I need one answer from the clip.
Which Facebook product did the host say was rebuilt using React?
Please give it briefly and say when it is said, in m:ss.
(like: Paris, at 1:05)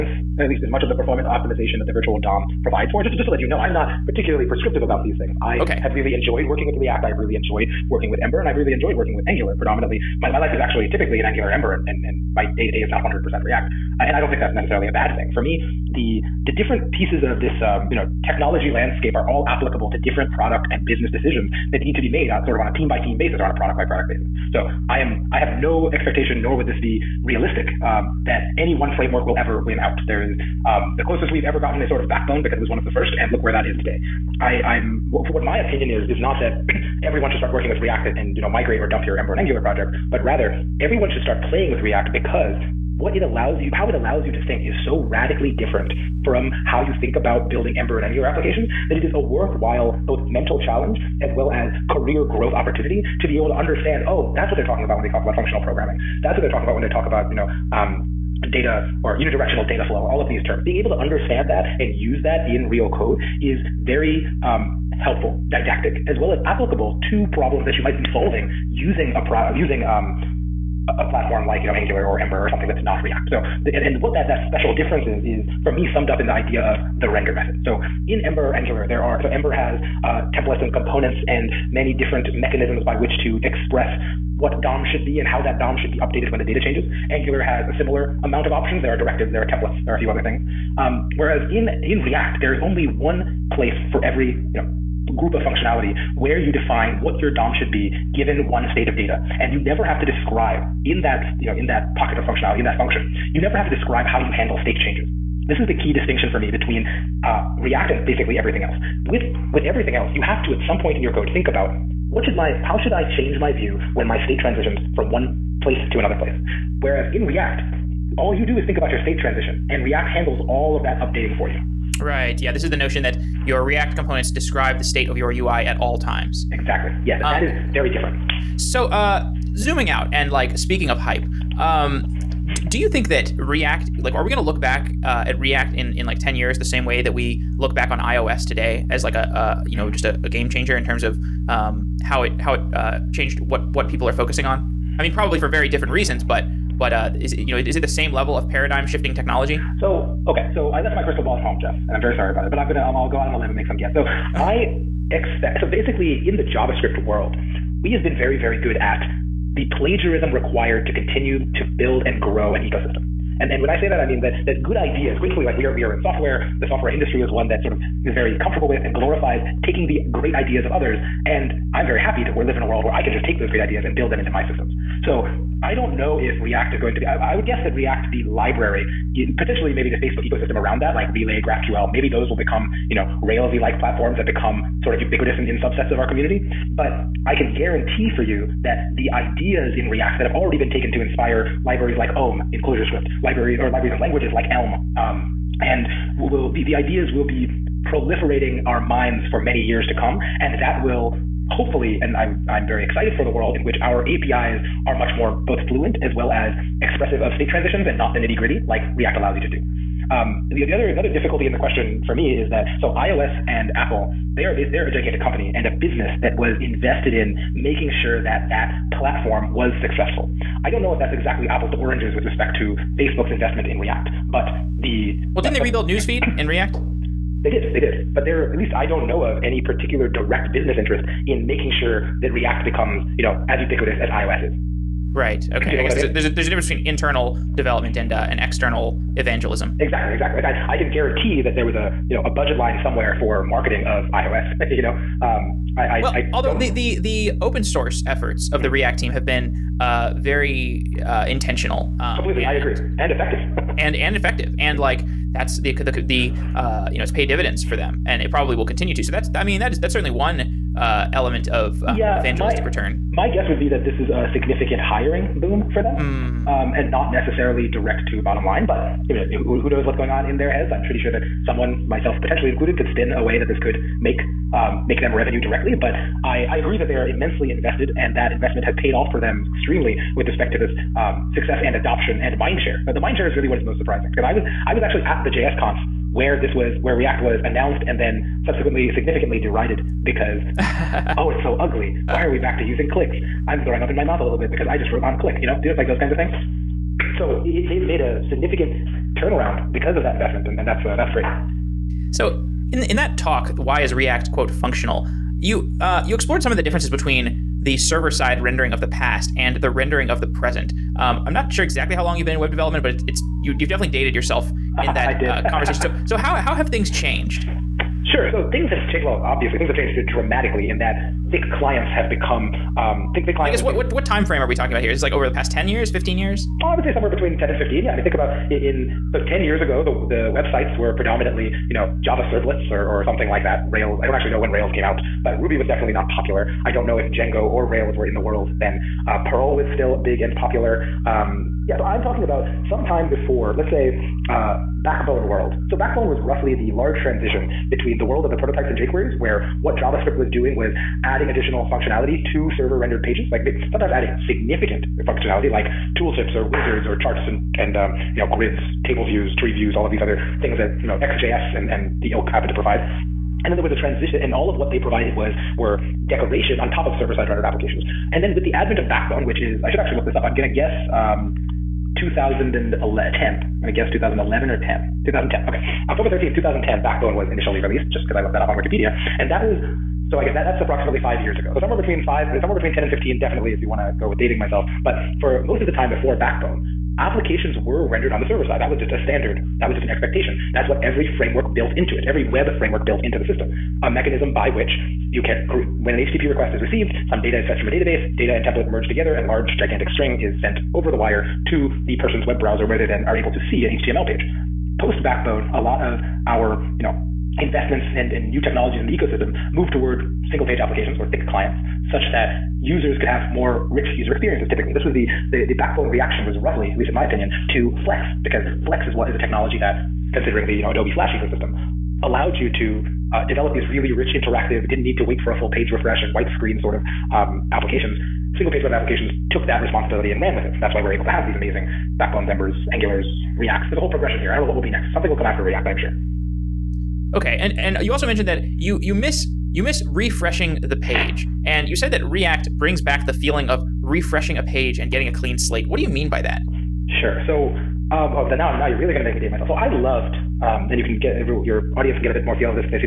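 Newsfeed, at 3:45.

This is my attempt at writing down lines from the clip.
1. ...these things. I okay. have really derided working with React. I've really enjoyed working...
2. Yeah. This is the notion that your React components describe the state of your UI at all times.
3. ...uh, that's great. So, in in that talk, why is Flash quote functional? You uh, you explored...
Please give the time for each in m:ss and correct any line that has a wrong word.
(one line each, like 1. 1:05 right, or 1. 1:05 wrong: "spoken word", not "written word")
1. 0:05 wrong: "enjoyed", not "derided"
2. 2:02 right
3. 5:00 wrong: "React", not "Flash".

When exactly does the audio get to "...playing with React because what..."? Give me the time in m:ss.
0:41.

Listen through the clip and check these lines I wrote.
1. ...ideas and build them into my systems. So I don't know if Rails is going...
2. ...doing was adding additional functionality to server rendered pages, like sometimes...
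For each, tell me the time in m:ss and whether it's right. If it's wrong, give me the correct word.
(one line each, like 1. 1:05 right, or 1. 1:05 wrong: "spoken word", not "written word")
1. 2:53 wrong: "React", not "Rails"
2. 5:50 right.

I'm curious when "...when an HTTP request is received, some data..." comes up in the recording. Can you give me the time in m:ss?
6:35.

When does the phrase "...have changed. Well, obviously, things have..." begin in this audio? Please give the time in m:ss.
5:18.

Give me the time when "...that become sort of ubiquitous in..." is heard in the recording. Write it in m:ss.
3:04.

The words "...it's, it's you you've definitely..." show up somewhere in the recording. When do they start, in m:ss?
5:12.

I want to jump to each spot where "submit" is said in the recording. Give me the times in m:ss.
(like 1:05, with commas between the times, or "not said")
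not said.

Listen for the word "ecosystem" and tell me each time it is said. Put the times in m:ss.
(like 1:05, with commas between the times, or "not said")
2:42, 3:00, 6:48, 7:01.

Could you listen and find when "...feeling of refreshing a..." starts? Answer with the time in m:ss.
7:23.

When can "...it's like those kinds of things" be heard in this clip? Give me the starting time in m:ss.
4:55.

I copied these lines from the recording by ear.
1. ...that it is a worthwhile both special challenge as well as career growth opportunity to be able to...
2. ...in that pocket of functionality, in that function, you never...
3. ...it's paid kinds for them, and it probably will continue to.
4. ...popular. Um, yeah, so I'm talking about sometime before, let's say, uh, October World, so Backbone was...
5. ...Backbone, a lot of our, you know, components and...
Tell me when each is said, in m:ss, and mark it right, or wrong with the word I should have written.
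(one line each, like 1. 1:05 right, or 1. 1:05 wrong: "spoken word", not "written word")
1. 0:48 wrong: "mental", not "special"
2. 1:41 right
3. 4:17 wrong: "dividends", not "kinds"
4. 5:40 wrong: "Backbone", not "October"
5. 6:45 wrong: "investments", not "components".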